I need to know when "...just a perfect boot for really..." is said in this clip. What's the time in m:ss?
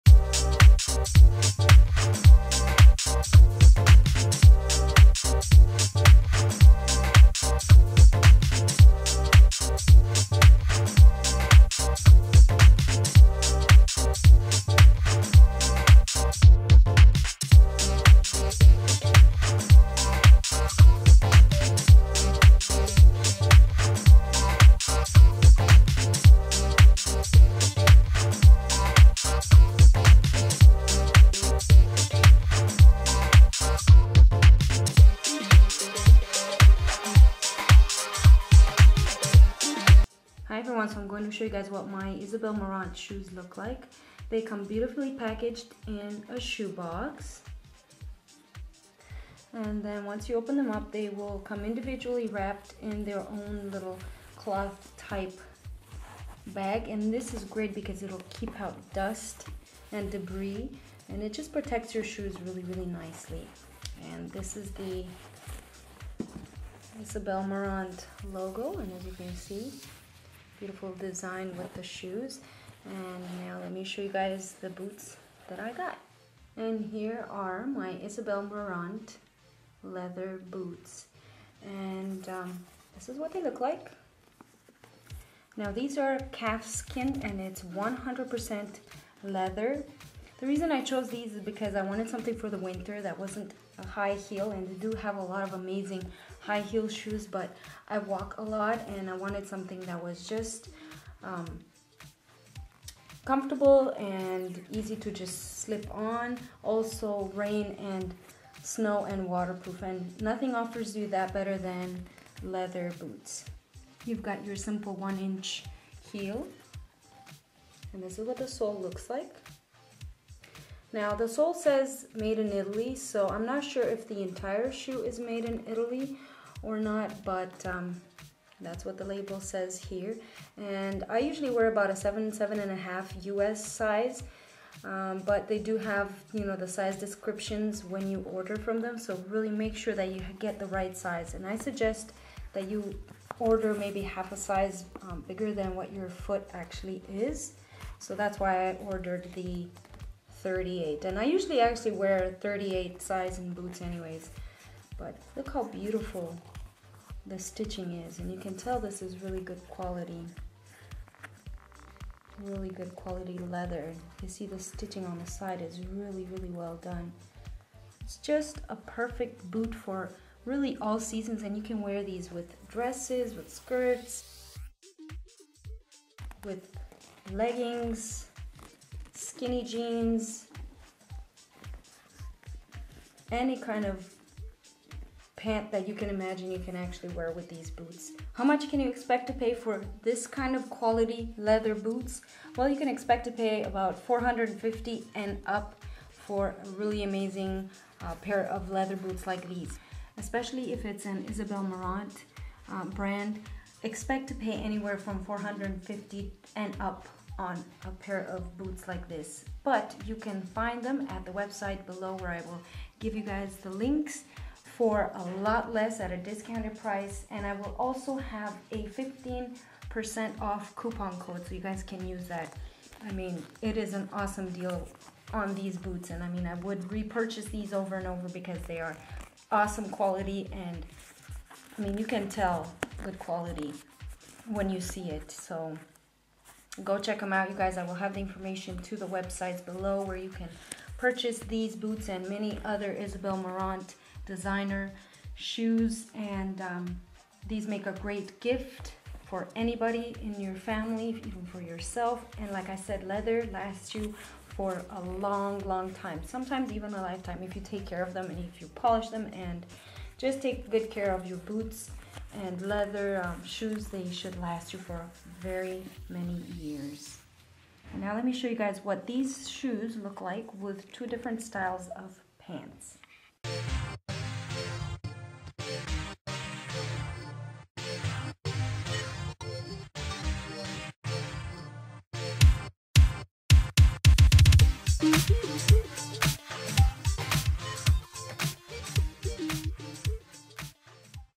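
2:48.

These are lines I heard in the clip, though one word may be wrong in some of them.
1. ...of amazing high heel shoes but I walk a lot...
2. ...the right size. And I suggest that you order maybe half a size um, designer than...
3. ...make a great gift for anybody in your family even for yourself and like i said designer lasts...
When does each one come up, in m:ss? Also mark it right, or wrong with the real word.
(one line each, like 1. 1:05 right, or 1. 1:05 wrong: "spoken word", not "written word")
1. 1:35 right
2. 2:20 wrong: "bigger", not "designer"
3. 4:07 wrong: "leather", not "designer".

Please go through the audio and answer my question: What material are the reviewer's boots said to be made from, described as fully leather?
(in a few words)
calf skin.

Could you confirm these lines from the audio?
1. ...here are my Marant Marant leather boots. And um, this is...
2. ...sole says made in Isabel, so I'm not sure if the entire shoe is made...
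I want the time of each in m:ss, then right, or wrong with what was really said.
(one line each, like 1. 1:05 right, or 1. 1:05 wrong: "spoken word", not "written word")
1. 1:16 wrong: "Isabel", not "Marant"
2. 2:01 wrong: "Italy", not "Isabel".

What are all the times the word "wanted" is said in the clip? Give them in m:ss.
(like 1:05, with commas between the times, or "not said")
1:31, 1:39.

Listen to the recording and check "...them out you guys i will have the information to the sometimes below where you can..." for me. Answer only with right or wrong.
wrong.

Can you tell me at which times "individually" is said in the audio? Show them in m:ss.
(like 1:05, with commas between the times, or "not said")
0:51.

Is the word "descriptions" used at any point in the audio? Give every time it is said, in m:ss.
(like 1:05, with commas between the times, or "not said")
2:16.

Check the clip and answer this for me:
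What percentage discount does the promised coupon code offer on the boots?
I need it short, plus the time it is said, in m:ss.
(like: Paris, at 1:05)
15%, at 3:38.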